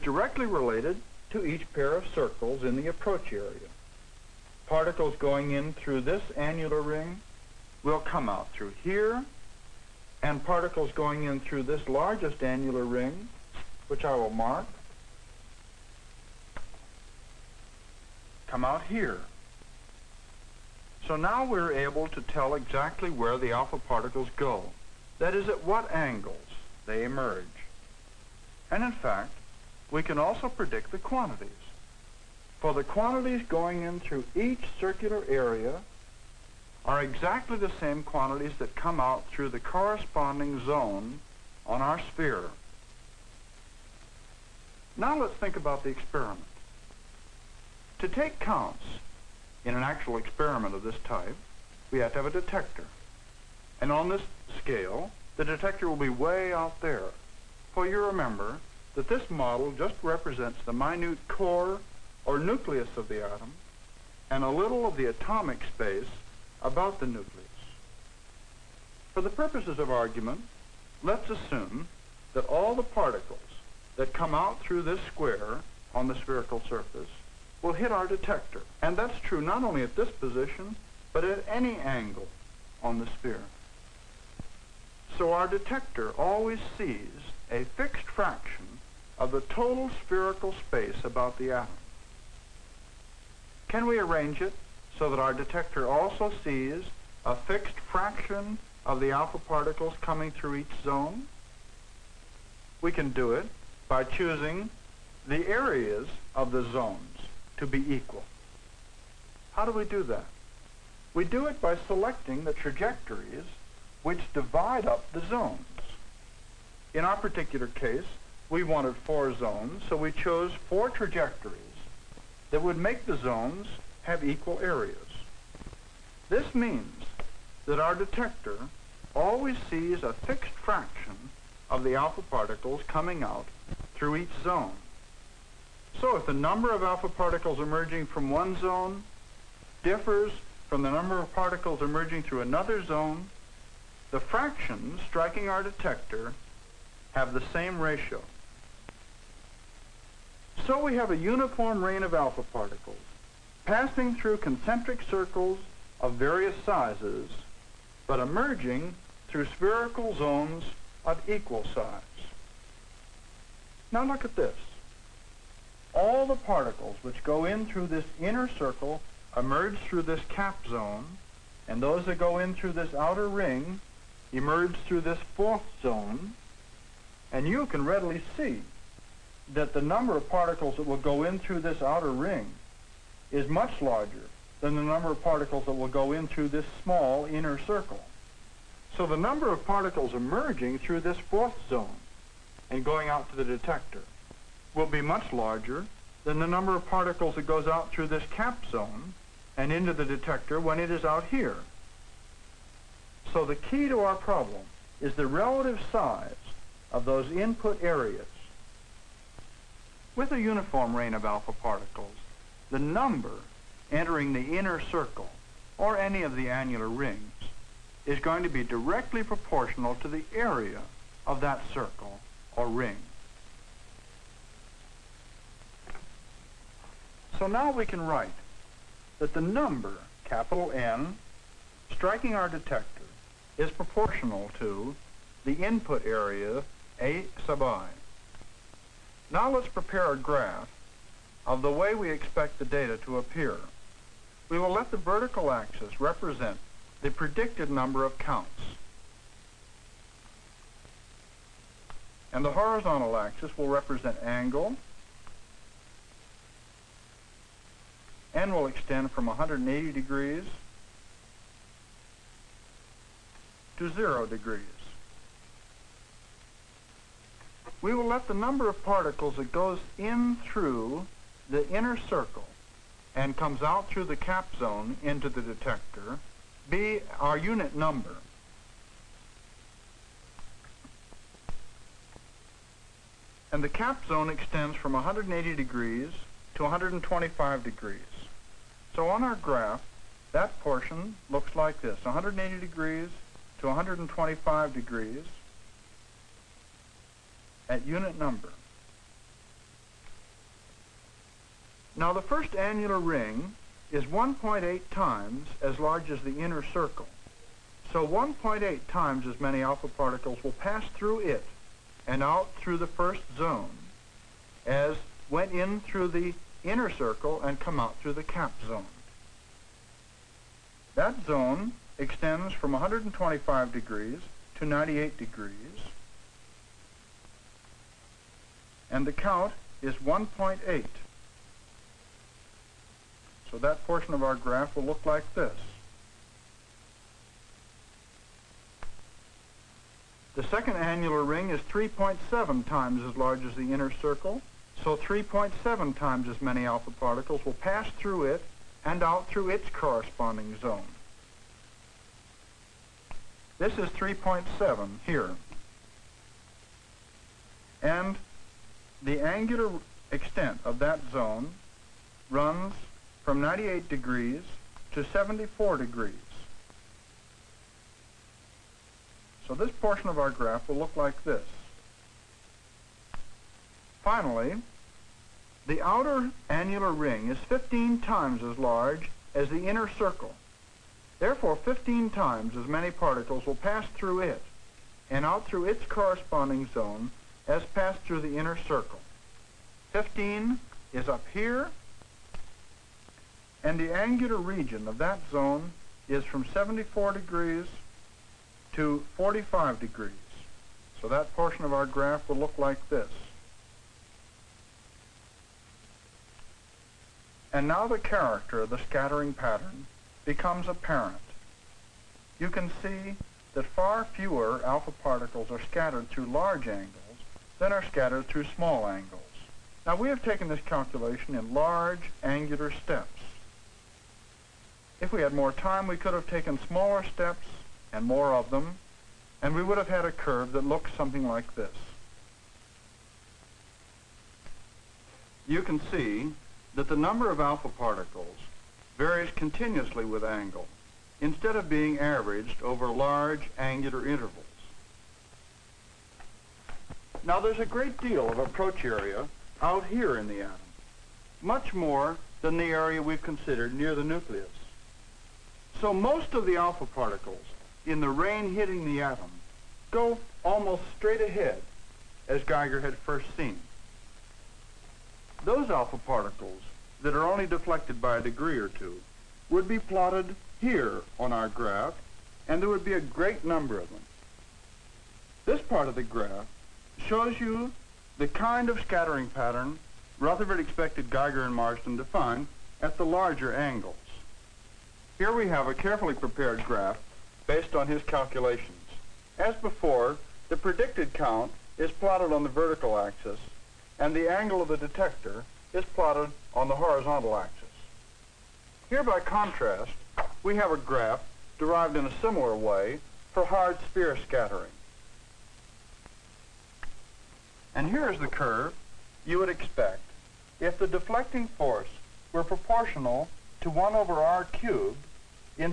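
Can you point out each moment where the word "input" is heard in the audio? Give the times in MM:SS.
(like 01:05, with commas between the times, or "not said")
03:27, 03:55.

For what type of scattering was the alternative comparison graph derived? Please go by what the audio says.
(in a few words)
hard sphere scattering.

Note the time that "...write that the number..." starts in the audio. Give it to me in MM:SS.
03:47.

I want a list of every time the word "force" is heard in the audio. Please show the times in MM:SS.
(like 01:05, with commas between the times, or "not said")
08:31.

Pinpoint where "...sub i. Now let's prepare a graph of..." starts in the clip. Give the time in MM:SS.
03:57.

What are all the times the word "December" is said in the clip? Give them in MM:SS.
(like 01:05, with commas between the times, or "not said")
not said.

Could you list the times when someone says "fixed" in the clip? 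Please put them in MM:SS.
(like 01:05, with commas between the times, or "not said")
01:27, 01:37, 02:10.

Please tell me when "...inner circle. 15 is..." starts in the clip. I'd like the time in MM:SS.
06:28.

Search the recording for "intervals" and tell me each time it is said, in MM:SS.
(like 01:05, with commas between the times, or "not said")
07:24.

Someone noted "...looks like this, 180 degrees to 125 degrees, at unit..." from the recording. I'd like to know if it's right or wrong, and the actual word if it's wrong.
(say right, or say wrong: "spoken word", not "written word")
right.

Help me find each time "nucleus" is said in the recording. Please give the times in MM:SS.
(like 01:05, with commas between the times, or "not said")
01:02, 01:07, 07:34.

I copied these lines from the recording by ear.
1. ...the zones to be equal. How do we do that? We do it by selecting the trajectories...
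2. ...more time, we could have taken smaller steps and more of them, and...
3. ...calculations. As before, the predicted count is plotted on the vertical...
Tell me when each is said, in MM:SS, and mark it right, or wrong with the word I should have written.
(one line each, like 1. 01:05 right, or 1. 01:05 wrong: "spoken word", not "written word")
1. 01:46 right
2. 07:05 right
3. 08:08 right.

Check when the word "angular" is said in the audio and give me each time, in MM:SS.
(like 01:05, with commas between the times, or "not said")
05:59, 06:33, 07:02, 07:23.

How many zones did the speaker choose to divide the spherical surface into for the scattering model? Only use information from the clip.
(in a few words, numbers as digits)
4.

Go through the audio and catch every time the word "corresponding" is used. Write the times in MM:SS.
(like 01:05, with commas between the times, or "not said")
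00:39, 05:49, 06:25.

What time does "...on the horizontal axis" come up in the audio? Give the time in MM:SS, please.
08:16.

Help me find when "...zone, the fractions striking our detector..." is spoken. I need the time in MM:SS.
02:22.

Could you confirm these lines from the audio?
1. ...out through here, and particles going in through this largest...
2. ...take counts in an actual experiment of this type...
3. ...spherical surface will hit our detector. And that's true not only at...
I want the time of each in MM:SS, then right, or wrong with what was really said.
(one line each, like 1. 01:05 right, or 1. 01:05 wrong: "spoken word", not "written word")
1. 00:08 right
2. 00:48 right
3. 01:16 right.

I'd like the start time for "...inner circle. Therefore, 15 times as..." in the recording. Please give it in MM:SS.
06:19.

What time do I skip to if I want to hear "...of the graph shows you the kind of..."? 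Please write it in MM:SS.
07:55.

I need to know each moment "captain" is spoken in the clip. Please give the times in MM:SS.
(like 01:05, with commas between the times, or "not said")
not said.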